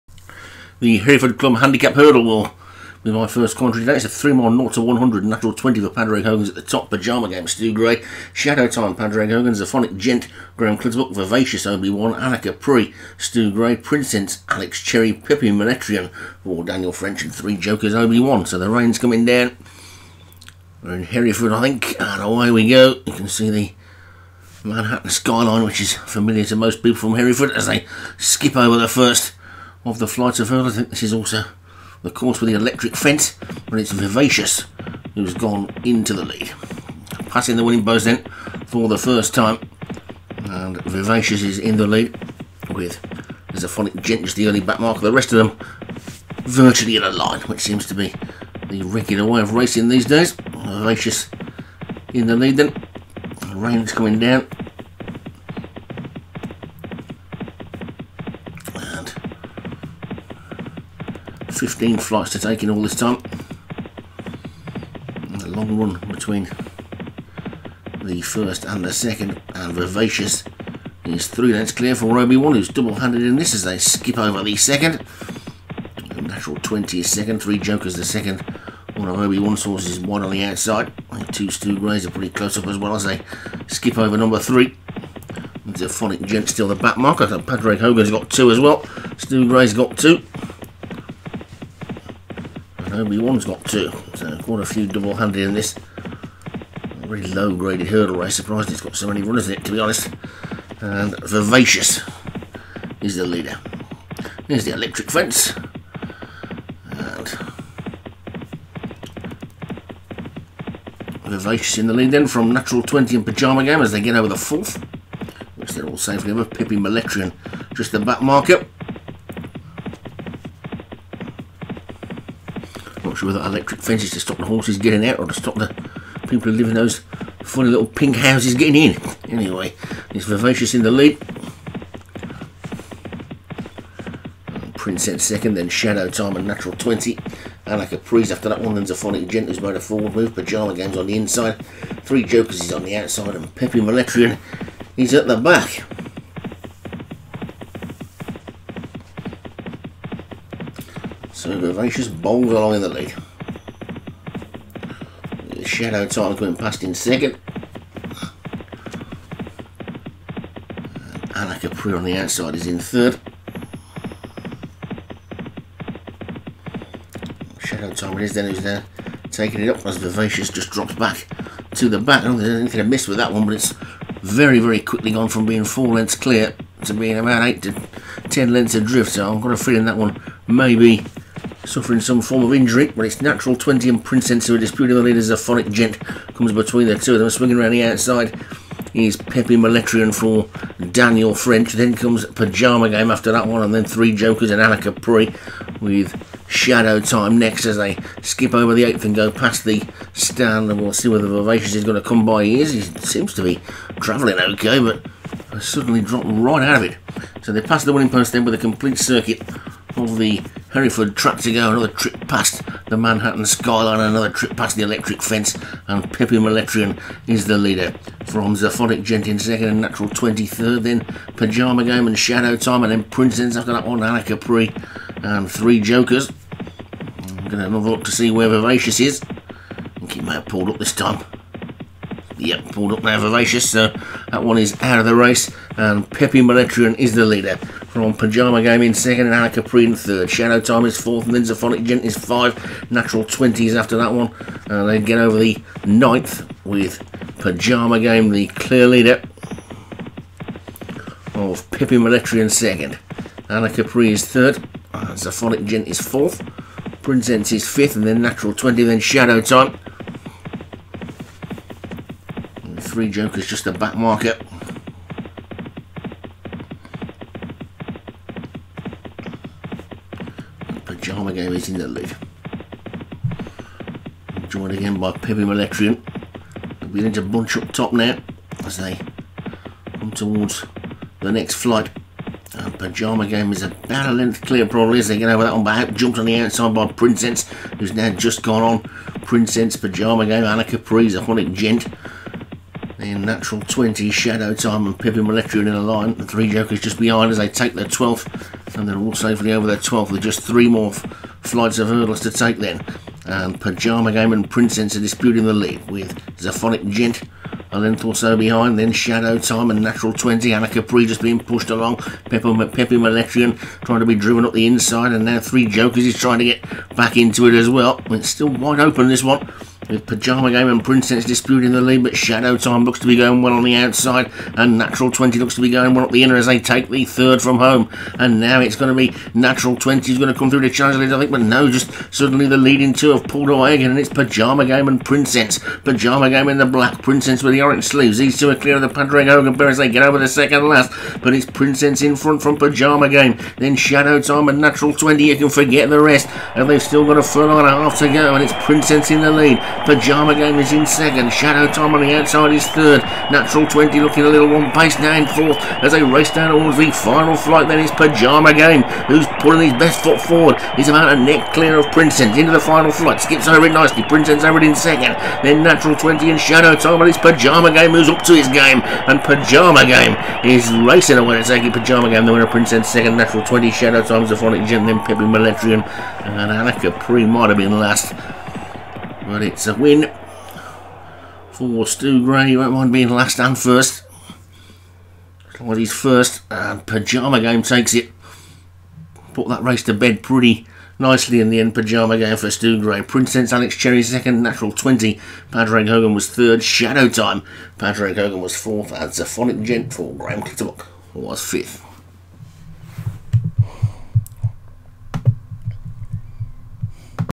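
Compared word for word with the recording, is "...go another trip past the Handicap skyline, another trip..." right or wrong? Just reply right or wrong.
wrong.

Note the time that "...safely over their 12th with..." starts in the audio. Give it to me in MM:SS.
04:59.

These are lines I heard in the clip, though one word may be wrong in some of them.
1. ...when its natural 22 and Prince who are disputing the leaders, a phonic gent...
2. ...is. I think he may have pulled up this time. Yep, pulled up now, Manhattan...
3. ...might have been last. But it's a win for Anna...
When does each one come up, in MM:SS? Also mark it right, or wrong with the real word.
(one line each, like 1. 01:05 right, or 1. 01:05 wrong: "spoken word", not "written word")
1. 03:02 wrong: "20", not "22"
2. 03:49 wrong: "Vivacious", not "Manhattan"
3. 06:17 wrong: "Stu", not "Anna".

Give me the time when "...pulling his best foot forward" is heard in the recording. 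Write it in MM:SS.
05:59.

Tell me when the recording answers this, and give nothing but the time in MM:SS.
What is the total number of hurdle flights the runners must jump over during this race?
01:01.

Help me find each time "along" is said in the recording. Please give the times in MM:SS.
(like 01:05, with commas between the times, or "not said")
02:32, 05:11.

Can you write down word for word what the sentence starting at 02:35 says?
Shadow Titan coming past in second.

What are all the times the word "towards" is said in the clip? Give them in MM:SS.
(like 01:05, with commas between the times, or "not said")
04:40, 05:56.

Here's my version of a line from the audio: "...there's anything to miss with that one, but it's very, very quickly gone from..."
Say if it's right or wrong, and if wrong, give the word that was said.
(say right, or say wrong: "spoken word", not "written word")
right.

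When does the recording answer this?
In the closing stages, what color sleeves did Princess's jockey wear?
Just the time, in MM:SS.
05:37.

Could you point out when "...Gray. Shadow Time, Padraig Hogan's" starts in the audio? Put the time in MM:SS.
00:07.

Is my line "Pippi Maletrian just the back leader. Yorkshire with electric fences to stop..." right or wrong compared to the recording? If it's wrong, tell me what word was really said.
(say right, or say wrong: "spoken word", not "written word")
wrong: "marker", not "leader".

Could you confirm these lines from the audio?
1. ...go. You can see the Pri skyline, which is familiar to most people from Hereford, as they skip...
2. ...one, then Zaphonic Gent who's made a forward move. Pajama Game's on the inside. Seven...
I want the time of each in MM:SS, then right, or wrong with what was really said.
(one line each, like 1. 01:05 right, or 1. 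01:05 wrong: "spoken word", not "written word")
1. 00:22 wrong: "Manhattan", not "Pri"
2. 02:18 wrong: "Three", not "Seven".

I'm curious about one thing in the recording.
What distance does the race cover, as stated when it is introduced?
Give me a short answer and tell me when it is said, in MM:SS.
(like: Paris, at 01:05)
3 miles, at 00:04.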